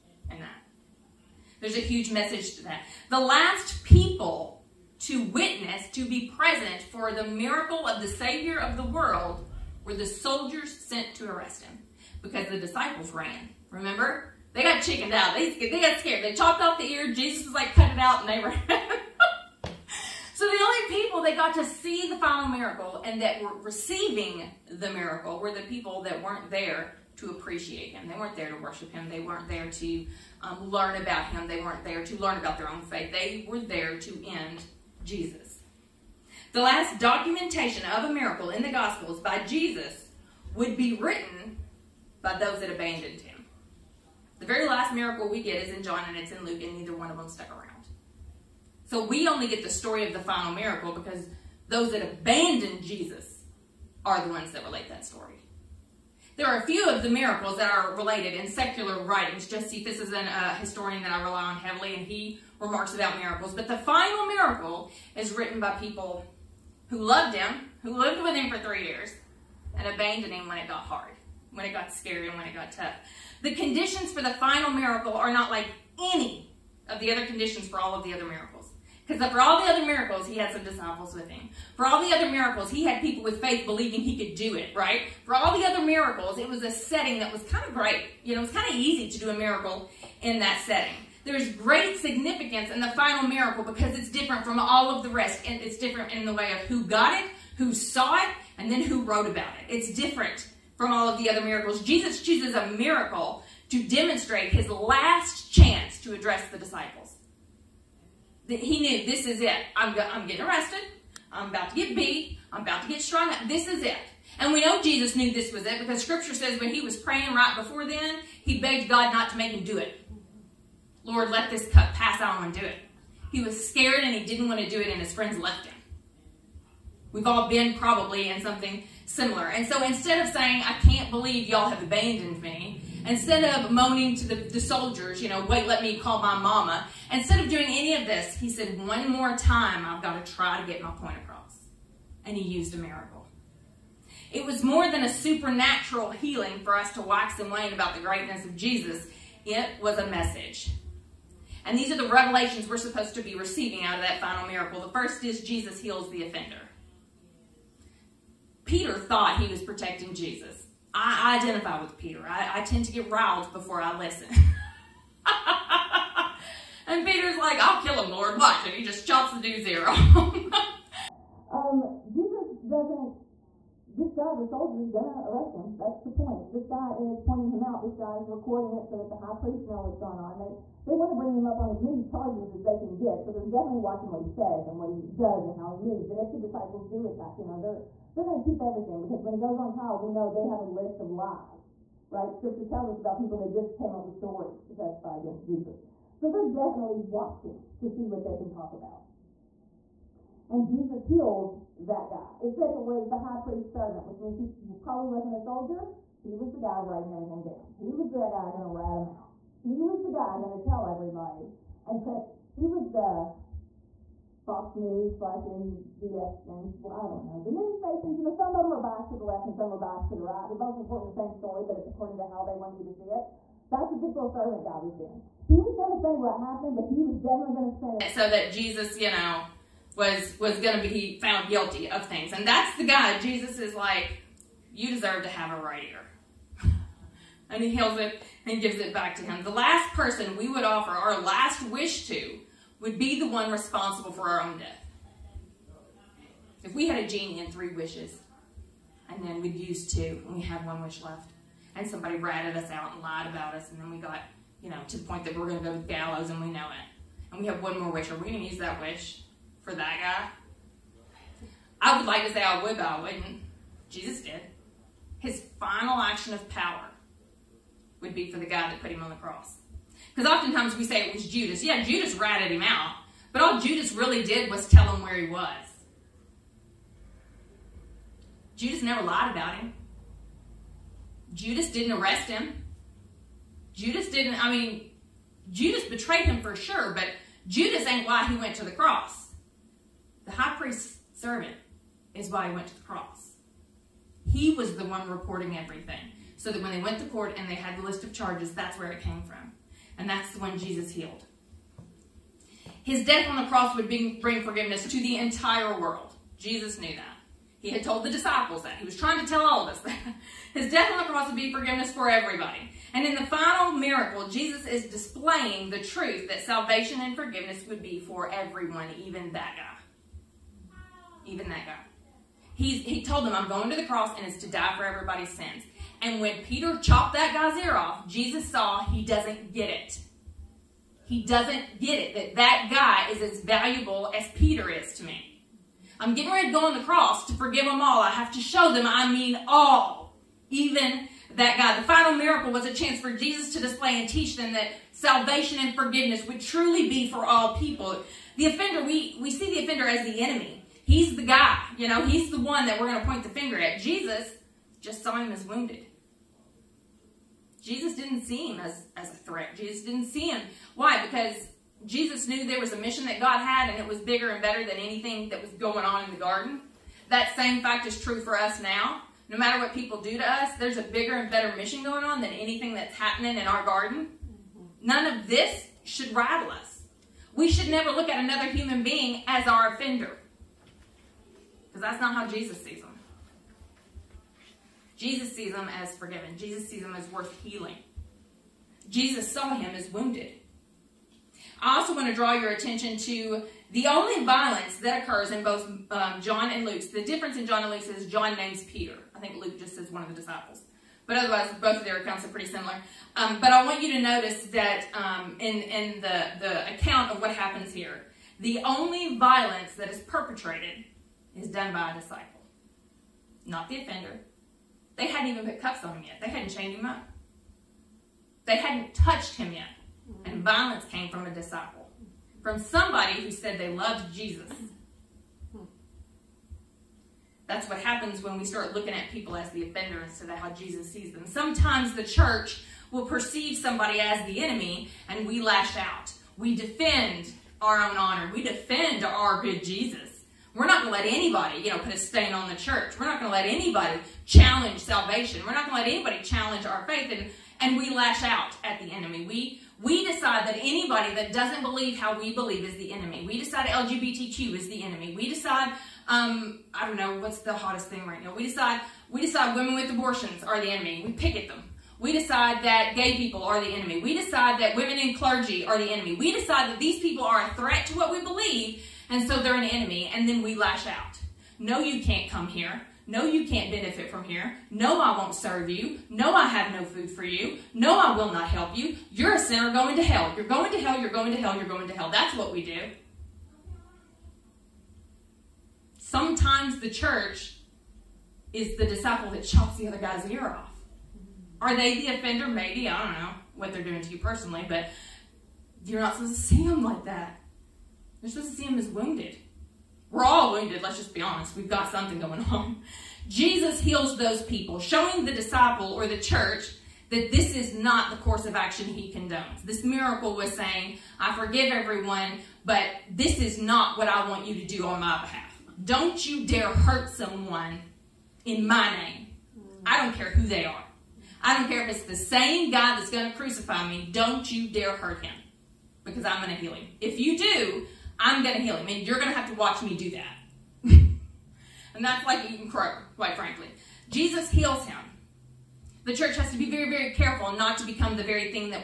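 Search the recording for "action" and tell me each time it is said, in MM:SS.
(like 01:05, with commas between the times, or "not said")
04:25, 08:28.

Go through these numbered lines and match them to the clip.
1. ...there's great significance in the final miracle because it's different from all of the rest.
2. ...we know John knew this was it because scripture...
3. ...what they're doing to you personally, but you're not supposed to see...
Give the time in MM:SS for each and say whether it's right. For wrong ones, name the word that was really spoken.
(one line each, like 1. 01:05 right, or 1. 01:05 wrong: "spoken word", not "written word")
1. 01:31 right
2. 01:54 wrong: "Jesus", not "John"
3. 08:13 right.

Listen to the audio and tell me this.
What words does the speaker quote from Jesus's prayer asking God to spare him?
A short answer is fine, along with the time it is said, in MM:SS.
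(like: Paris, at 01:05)
Lord, let this cup pass, at 02:01.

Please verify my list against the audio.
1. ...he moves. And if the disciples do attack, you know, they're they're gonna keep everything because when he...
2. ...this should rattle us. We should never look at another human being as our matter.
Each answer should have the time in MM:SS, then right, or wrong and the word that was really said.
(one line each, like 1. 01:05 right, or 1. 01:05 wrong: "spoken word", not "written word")
1. 03:05 right
2. 06:15 wrong: "offender", not "matter".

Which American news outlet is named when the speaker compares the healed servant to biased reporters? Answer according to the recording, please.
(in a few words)
Fox News.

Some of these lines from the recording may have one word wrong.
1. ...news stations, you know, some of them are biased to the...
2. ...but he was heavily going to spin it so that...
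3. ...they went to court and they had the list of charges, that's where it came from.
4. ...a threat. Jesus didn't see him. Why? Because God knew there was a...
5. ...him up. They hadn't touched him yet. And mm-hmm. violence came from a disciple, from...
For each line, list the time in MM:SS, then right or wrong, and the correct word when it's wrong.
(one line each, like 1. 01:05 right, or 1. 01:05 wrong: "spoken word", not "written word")
1. 03:37 right
2. 03:46 wrong: "definitely", not "heavily"
3. 04:56 right
4. 05:59 wrong: "Jesus", not "God"
5. 06:56 right.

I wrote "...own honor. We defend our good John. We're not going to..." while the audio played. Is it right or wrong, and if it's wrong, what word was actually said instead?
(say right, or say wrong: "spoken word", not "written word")
wrong: "Jesus", not "John".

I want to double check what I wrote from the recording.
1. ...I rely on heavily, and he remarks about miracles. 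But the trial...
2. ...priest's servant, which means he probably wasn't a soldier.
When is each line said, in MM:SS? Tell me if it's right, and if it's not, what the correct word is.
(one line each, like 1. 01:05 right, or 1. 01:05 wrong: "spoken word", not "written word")
1. 01:01 wrong: "final", not "trial"
2. 03:23 right.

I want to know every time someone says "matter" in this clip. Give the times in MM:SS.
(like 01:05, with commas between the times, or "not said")
06:09.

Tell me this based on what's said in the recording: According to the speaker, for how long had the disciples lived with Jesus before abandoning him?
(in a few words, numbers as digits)
3 years.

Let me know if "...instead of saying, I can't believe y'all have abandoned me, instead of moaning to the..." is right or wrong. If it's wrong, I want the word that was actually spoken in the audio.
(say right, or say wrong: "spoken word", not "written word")
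right.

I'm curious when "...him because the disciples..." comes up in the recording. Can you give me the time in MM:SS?
00:11.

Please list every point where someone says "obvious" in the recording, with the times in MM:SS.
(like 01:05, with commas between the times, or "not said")
not said.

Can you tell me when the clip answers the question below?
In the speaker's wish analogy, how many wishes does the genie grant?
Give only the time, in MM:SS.
04:07.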